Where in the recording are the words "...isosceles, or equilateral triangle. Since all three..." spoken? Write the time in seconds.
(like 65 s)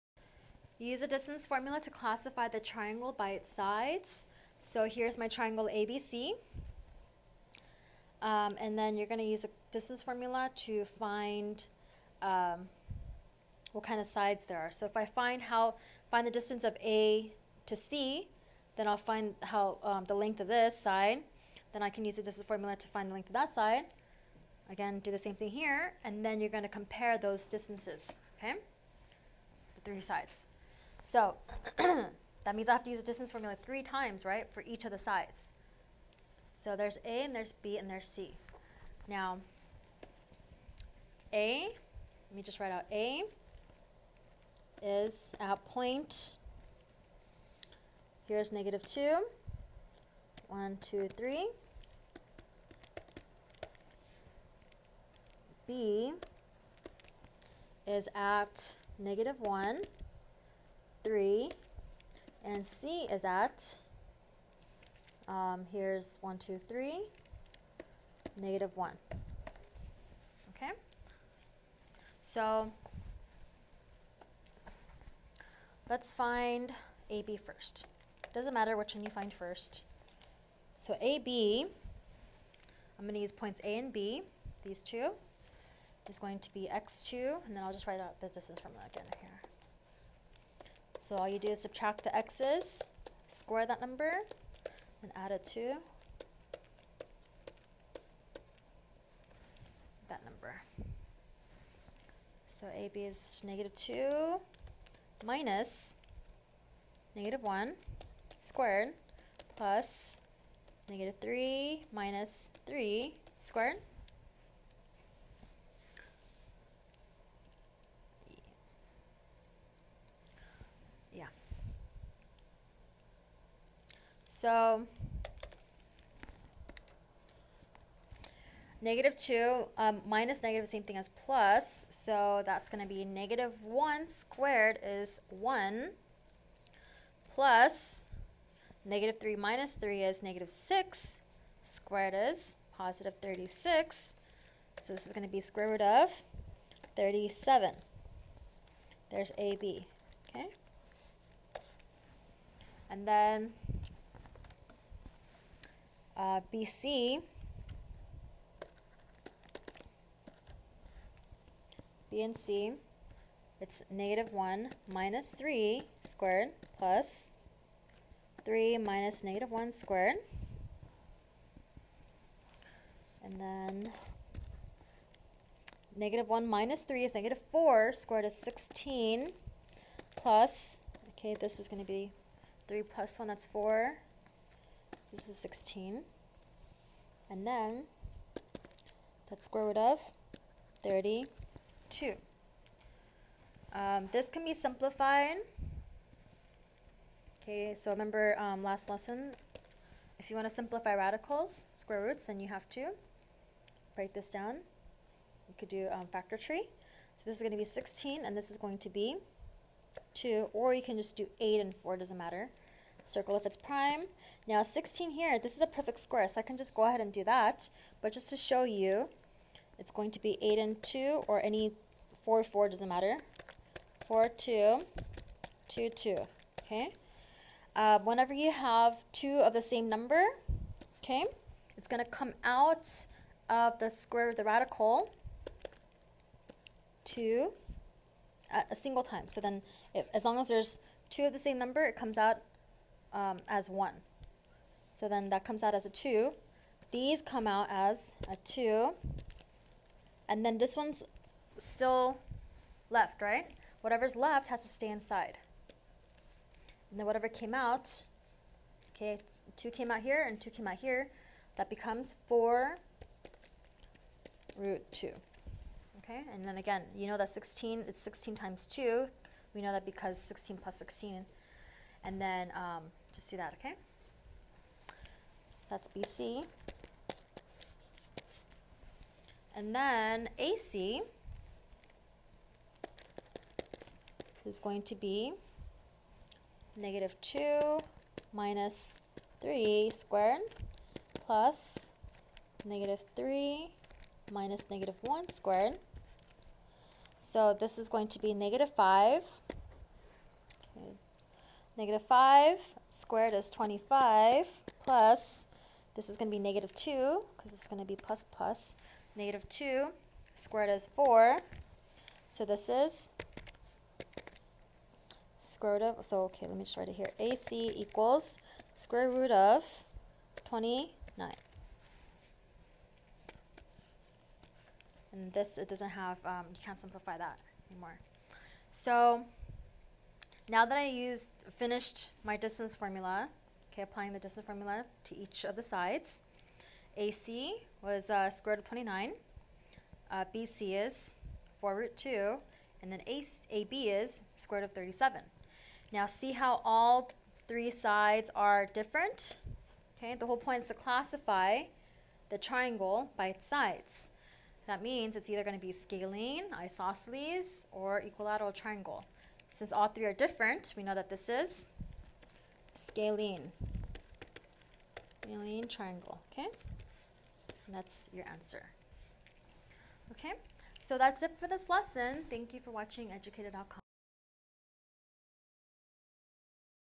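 356 s.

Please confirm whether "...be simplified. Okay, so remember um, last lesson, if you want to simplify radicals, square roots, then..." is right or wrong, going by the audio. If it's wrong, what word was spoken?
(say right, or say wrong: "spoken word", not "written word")
right.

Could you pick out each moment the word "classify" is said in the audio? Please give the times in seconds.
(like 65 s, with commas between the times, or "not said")
1 s, 350 s.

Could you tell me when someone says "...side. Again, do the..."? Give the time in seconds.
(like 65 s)
23 s.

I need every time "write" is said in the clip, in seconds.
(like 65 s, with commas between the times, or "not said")
42 s, 87 s, 316 s.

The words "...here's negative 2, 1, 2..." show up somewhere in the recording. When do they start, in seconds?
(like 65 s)
48 s.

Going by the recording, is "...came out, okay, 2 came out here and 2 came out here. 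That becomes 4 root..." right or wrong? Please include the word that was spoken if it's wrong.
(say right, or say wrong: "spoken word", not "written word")
right.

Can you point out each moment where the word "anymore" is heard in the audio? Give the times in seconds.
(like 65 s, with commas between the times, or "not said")
327 s.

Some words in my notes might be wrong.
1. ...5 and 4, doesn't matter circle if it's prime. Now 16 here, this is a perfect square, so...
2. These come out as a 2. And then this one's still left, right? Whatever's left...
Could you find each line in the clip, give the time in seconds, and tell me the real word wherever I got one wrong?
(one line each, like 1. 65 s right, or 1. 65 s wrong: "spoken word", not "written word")
1. 211 s wrong: "8", not "5"
2. 246 s right.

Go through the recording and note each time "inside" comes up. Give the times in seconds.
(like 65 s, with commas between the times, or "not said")
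254 s.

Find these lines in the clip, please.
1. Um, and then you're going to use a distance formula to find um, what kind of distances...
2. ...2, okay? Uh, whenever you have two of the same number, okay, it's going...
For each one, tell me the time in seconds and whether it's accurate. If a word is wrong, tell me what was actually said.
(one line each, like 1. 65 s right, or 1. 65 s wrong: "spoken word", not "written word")
1. 8 s wrong: "sides", not "distances"
2. 225 s right.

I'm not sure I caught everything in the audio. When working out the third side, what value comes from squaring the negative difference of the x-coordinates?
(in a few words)
25.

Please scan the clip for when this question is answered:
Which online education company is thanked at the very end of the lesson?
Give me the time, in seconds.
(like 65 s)
373 s.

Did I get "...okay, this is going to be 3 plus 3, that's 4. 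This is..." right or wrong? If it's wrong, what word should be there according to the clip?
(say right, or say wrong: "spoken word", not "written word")
wrong: "1", not "3".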